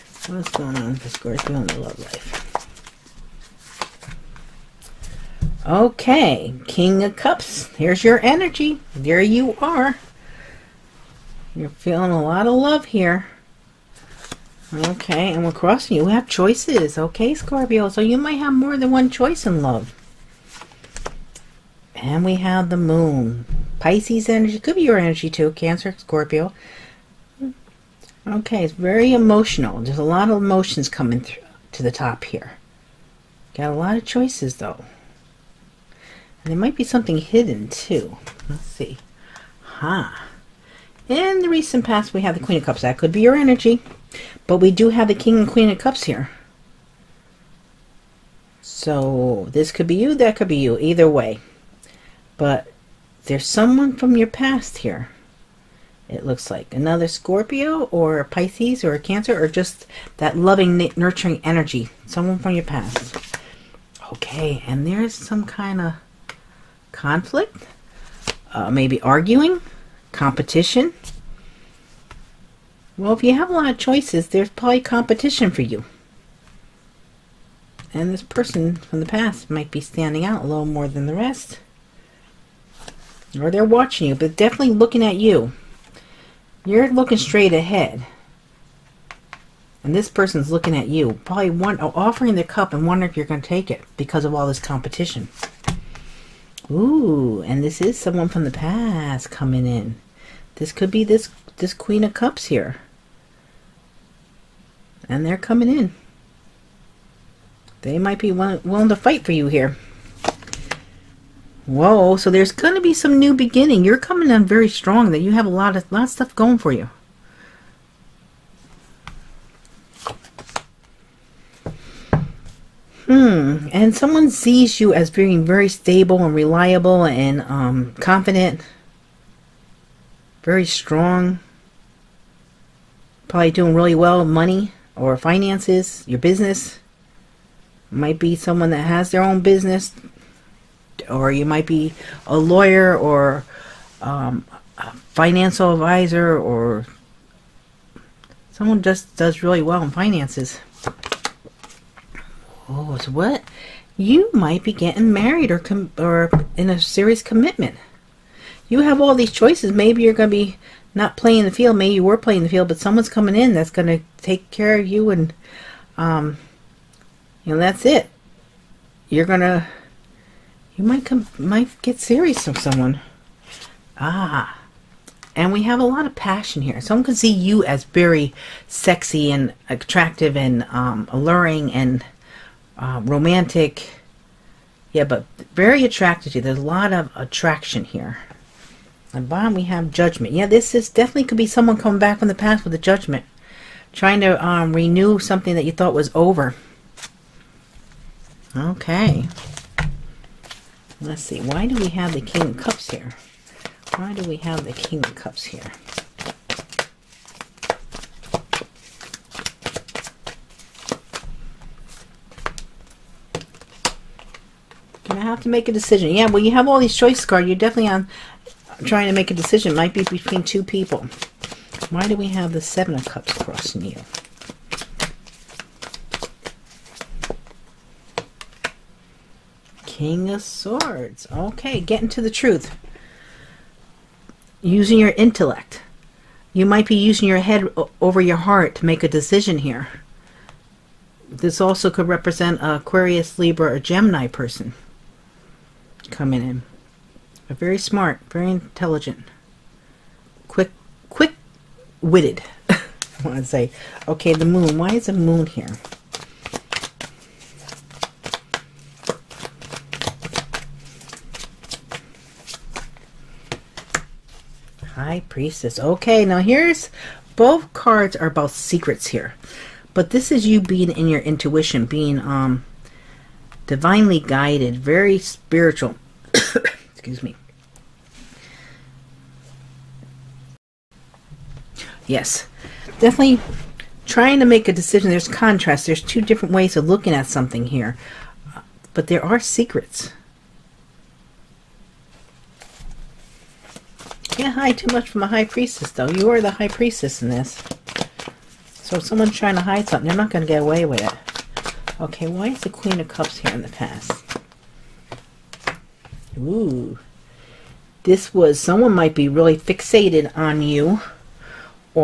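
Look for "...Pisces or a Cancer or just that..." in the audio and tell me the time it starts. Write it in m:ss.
0:58.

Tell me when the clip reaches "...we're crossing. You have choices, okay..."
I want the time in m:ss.
0:15.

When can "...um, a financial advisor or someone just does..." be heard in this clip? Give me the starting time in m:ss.
2:24.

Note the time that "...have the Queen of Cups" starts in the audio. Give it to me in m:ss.
0:42.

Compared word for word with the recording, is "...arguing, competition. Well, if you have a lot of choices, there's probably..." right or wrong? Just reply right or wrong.
right.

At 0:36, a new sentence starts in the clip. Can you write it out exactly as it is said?
And there might be something hidden too.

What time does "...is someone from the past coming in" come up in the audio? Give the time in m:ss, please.
1:37.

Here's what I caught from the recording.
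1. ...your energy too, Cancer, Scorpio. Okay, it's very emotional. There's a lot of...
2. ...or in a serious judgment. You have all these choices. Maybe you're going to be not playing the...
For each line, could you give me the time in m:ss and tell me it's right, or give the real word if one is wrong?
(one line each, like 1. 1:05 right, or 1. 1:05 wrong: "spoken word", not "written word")
1. 0:24 right
2. 2:35 wrong: "commitment", not "judgment".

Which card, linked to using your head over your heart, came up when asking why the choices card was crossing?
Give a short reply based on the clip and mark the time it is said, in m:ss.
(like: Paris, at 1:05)
King of Swords, at 3:49.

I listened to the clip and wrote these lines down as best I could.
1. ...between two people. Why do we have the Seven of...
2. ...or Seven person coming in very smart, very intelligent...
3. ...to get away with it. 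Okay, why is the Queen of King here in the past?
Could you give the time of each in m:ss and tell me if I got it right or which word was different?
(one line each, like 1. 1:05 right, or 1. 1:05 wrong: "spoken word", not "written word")
1. 3:40 right
2. 4:03 wrong: "Gemini", not "Seven"
3. 5:00 wrong: "Cups", not "King".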